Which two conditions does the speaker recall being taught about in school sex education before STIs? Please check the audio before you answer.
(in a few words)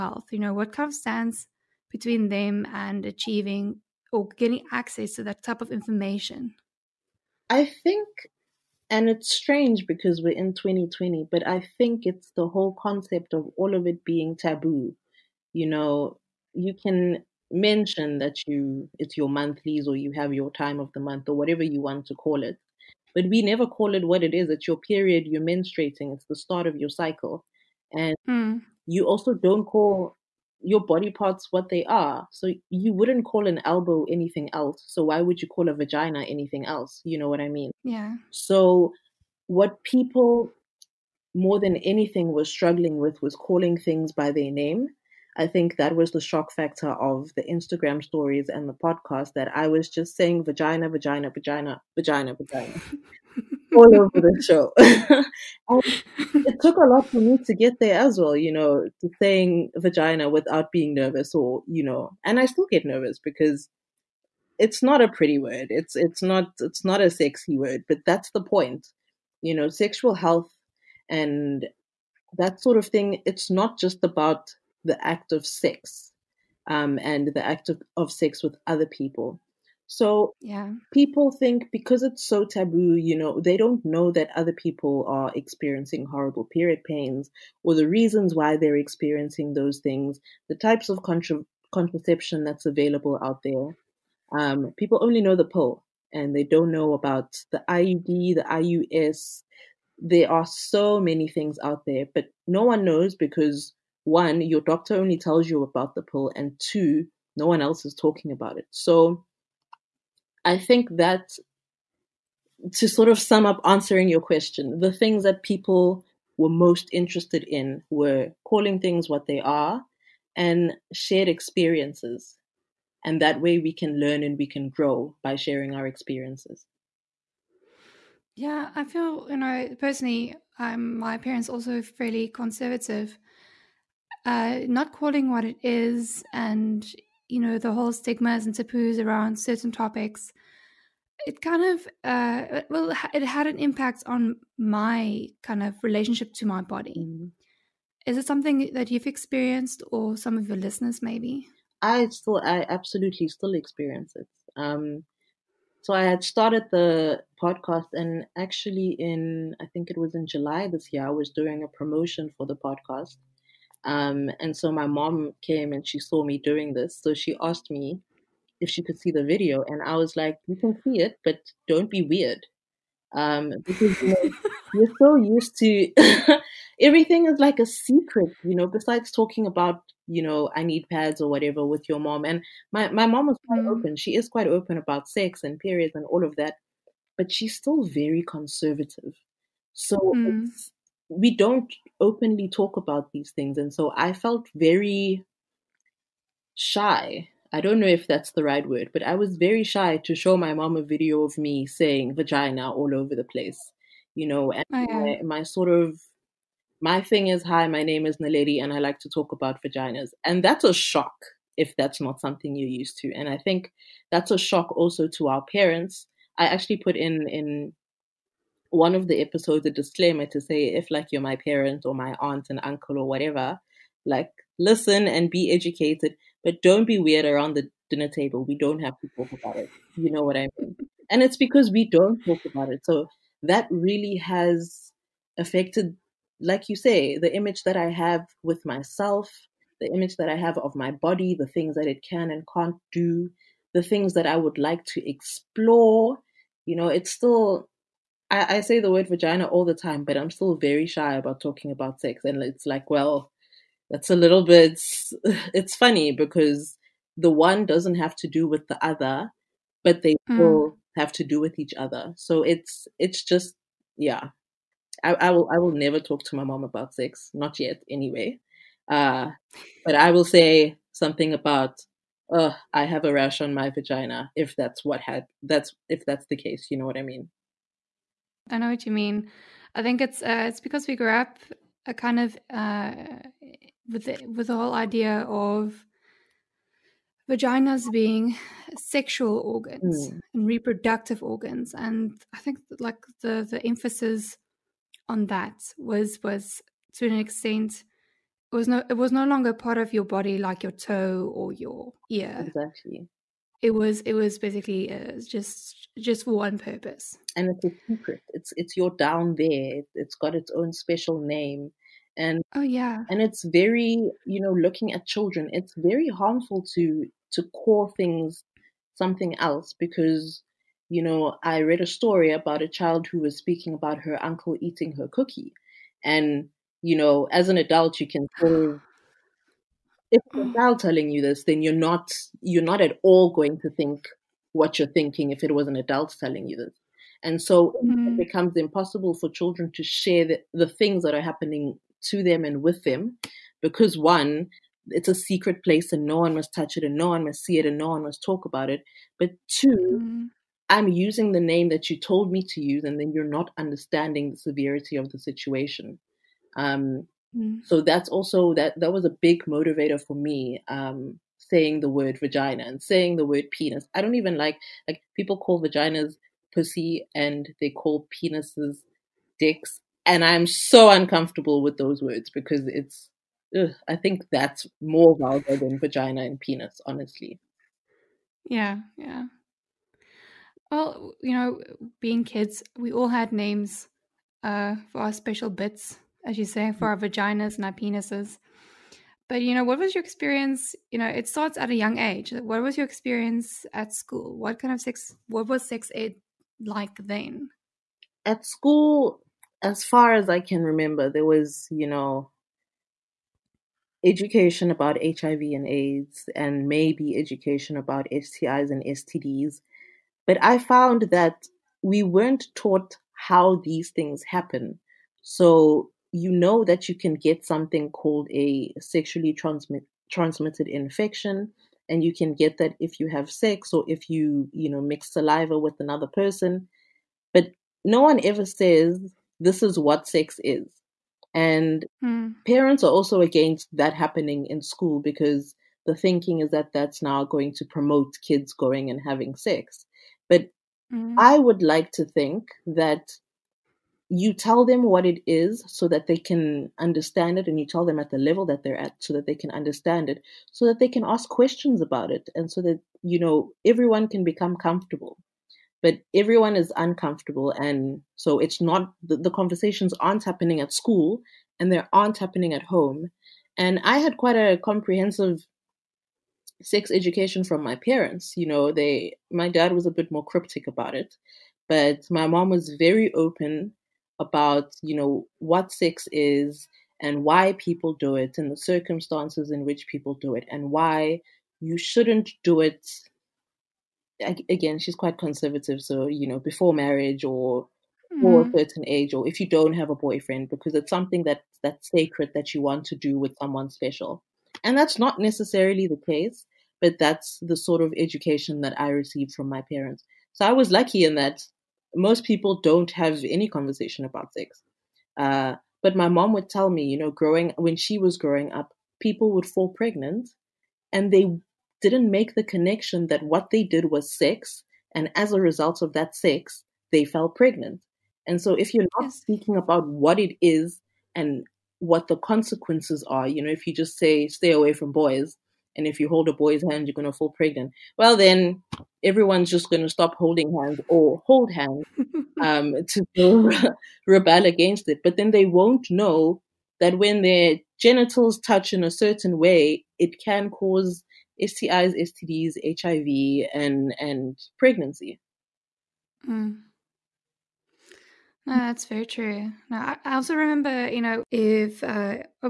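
HIV and AIDS.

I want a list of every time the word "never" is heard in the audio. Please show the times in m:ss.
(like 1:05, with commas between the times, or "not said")
0:23, 4:25.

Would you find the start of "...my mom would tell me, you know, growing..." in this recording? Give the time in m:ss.
8:25.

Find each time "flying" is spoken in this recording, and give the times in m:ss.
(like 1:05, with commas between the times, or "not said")
not said.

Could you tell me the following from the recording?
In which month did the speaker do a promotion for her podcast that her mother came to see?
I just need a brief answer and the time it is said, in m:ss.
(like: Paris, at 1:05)
July, at 2:40.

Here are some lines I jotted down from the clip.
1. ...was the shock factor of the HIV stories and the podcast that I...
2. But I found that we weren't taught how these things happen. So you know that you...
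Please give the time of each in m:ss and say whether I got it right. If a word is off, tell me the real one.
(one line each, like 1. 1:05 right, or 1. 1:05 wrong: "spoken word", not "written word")
1. 0:45 wrong: "Instagram", not "HIV"
2. 6:50 right.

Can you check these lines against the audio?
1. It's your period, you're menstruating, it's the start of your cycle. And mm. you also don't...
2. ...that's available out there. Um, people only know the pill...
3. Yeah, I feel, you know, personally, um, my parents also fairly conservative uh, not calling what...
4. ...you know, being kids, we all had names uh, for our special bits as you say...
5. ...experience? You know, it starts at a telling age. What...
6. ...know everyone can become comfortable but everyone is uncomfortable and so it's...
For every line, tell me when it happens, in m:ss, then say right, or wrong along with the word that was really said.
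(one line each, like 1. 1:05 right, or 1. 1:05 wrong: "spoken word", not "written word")
1. 0:24 right
2. 1:32 right
3. 2:08 right
4. 6:21 right
5. 6:30 wrong: "young", not "telling"
6. 7:33 right.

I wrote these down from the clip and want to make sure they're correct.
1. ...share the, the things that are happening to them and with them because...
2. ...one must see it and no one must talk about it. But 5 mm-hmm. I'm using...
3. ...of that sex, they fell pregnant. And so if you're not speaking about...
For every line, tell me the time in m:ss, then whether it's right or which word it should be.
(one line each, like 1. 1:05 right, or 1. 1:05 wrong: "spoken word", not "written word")
1. 5:39 right
2. 5:47 wrong: "2", not "5"
3. 8:35 right.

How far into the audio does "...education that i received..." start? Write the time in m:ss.
8:17.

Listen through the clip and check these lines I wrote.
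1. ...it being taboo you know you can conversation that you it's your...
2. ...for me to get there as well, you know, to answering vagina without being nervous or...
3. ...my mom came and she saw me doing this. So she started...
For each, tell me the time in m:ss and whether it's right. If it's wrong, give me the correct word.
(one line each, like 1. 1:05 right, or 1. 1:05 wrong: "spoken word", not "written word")
1. 0:13 wrong: "mention", not "conversation"
2. 0:57 wrong: "saying", not "answering"
3. 2:44 wrong: "asked", not "started".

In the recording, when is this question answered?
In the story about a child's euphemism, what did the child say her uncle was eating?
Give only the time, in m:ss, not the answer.
5:24.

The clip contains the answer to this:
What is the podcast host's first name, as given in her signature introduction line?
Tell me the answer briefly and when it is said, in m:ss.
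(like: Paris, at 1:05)
Naledi, at 3:28.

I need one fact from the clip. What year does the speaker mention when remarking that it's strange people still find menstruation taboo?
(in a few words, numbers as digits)
2020.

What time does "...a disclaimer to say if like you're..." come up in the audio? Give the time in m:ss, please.
3:39.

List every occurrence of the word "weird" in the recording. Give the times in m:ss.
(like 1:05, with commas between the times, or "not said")
2:52, 3:46.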